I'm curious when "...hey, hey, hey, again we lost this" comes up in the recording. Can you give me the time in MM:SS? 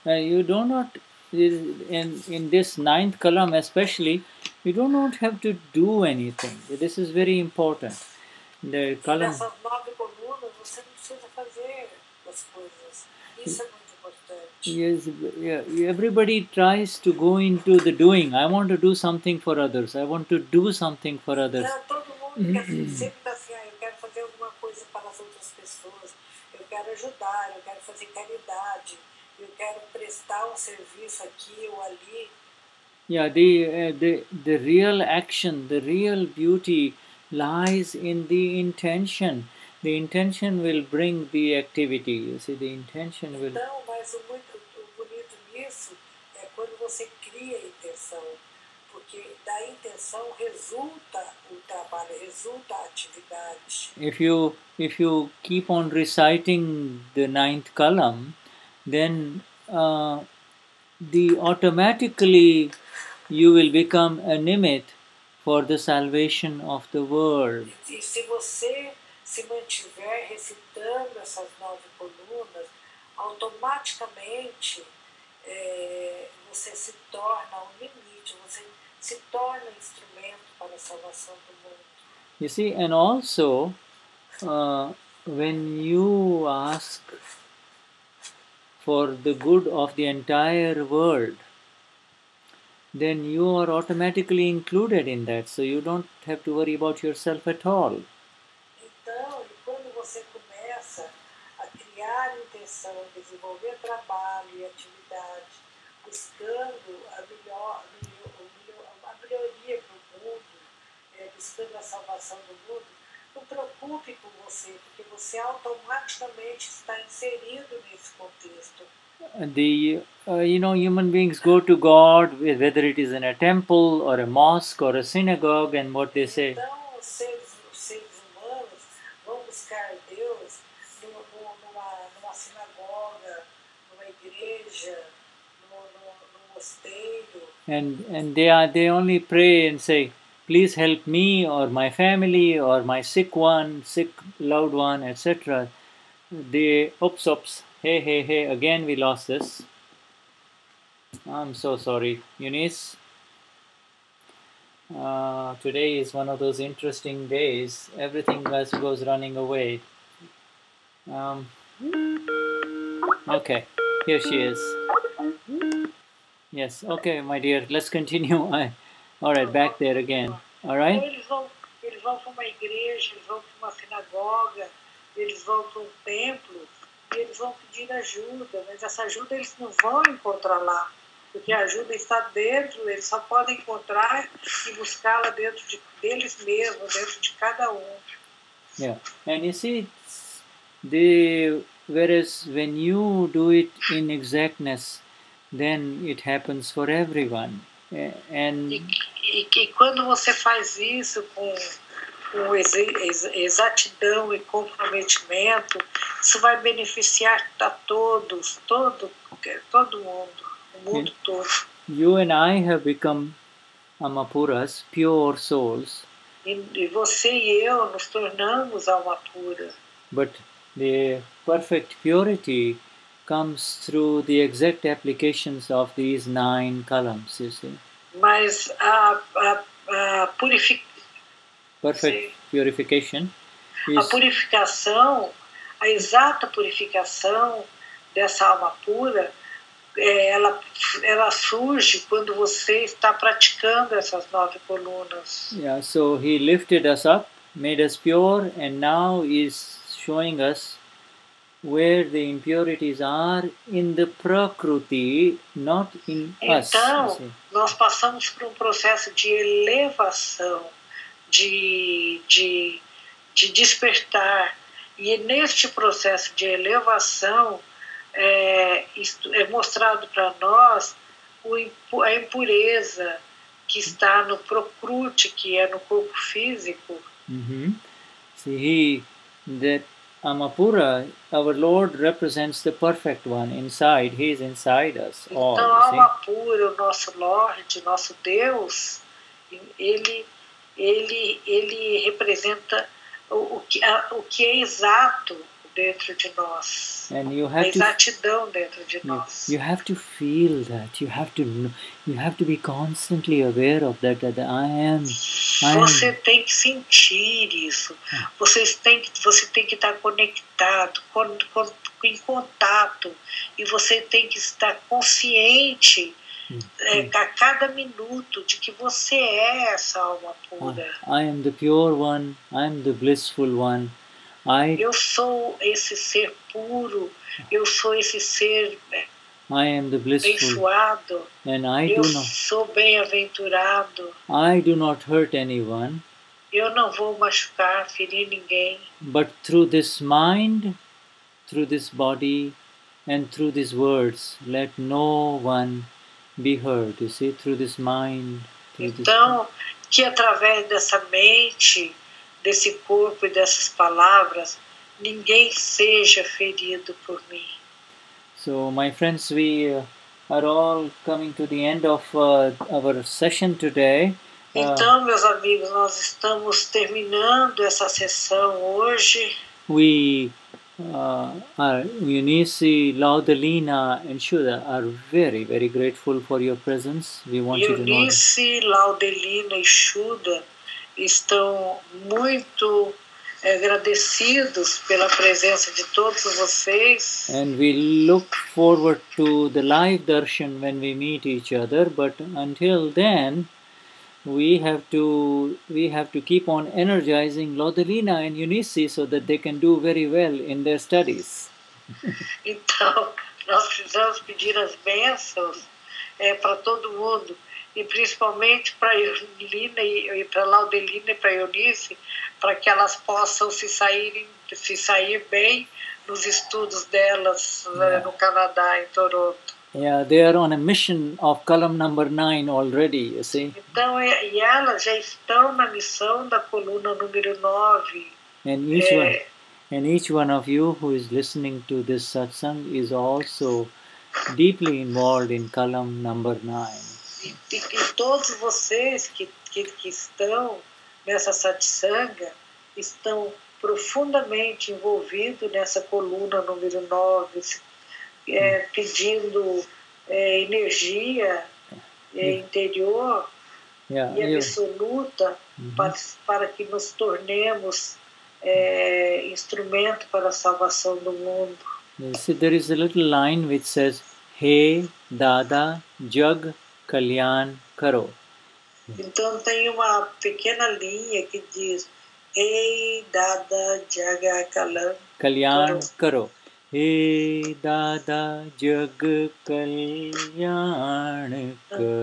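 02:27.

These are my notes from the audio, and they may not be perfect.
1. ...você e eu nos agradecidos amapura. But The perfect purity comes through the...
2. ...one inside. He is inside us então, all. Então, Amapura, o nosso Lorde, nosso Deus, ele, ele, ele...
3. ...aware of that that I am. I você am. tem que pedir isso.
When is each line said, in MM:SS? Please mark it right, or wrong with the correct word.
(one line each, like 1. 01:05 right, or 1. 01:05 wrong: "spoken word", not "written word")
1. 03:36 wrong: "tornamos", not "agradecidos"
2. 04:43 right
3. 05:03 wrong: "sentir", not "pedir".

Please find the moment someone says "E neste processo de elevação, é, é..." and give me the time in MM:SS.
04:24.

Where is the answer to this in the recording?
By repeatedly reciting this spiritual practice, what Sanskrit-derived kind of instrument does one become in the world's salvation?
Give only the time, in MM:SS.
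01:04.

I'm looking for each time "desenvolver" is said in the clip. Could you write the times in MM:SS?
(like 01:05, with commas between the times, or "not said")
01:43.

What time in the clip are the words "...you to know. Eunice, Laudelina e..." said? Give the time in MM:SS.
06:17.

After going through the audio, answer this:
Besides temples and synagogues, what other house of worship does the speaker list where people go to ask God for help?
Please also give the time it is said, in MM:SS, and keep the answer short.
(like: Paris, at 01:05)
A mosque, at 02:04.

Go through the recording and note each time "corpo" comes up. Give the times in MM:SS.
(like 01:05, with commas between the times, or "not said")
04:35, 05:52.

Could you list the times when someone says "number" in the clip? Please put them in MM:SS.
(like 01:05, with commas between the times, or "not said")
07:01, 07:16.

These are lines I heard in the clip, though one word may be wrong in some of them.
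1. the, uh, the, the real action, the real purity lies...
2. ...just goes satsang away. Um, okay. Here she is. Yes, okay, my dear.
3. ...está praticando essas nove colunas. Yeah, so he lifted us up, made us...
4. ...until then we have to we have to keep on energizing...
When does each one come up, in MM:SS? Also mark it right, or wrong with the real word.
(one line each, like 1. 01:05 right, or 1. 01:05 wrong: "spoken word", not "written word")
1. 00:33 wrong: "beauty", not "purity"
2. 02:38 wrong: "running", not "satsang"
3. 04:02 right
4. 06:32 right.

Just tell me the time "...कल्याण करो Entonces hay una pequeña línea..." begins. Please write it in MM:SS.
07:46.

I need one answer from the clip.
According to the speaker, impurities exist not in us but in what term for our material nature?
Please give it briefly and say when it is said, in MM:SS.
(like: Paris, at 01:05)
Prakruti, at 04:14.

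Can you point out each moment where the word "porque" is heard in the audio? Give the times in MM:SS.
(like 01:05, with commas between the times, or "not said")
00:48, 01:54, 03:01.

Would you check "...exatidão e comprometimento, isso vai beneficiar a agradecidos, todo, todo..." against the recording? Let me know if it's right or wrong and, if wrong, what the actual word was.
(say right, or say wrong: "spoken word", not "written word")
wrong: "todos", not "agradecidos".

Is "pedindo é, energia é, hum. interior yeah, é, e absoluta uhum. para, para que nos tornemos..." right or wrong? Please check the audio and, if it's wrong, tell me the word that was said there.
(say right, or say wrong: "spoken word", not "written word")
right.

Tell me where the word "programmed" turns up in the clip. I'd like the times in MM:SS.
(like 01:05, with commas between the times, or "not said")
not said.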